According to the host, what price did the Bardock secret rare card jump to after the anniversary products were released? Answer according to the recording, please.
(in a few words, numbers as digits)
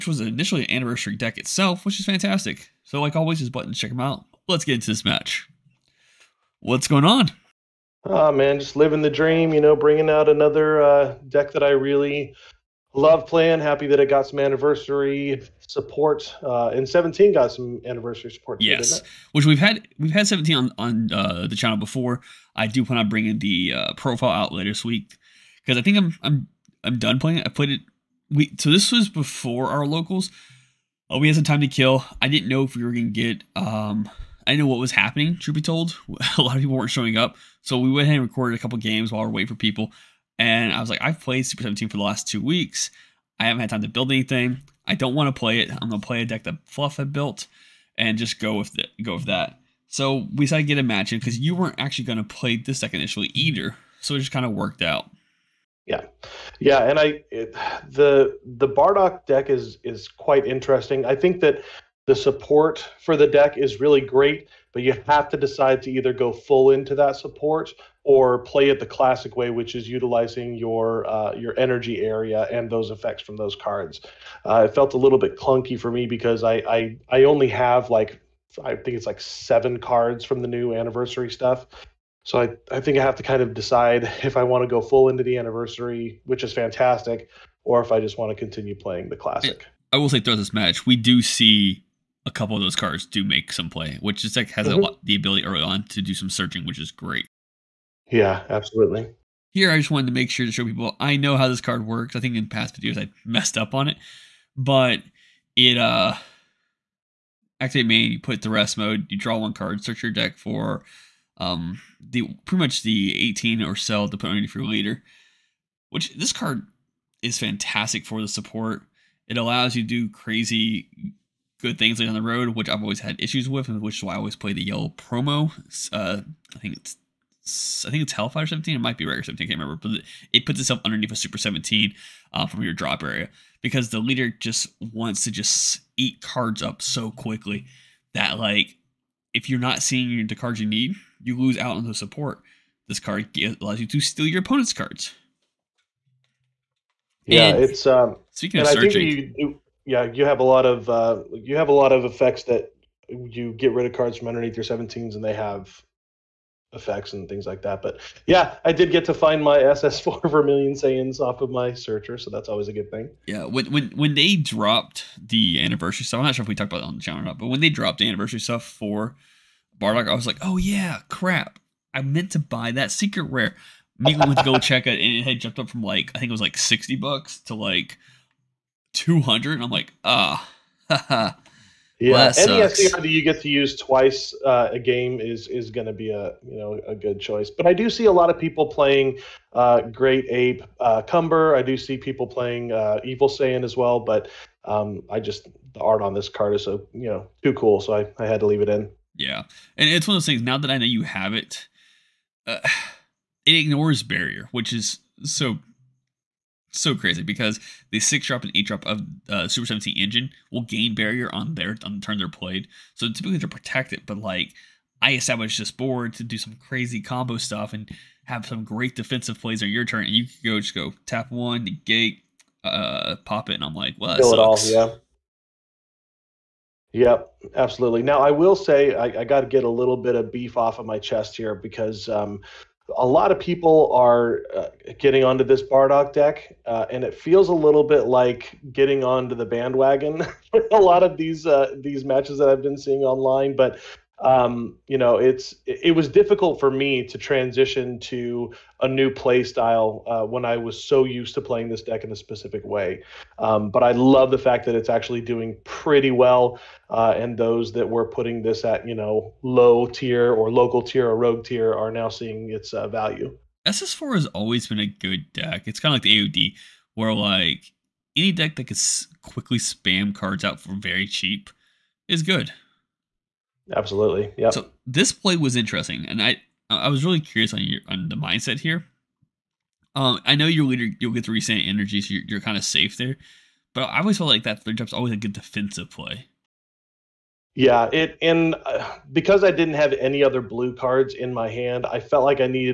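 $200.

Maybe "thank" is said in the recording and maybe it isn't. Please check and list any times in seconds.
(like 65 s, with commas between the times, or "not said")
not said.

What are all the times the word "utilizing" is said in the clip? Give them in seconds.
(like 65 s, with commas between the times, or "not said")
69 s.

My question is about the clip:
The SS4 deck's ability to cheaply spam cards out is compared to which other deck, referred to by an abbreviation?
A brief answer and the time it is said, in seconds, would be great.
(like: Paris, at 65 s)
AOD, at 266 s.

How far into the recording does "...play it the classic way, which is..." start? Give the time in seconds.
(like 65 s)
68 s.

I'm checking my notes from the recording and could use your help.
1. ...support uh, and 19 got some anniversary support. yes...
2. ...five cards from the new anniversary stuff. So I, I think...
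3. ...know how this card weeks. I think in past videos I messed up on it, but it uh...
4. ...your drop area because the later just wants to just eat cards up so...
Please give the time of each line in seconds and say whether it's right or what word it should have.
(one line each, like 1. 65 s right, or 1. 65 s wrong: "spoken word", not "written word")
1. 15 s wrong: "17", not "19"
2. 79 s wrong: "seven", not "five"
3. 101 s wrong: "works", not "weeks"
4. 132 s wrong: "leader", not "later".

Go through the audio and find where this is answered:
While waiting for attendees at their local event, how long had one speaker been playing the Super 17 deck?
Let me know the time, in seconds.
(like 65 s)
42 s.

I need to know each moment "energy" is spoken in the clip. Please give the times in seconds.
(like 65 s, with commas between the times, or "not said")
71 s, 281 s.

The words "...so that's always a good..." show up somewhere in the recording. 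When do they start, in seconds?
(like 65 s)
162 s.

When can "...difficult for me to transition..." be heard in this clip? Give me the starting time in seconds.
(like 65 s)
246 s.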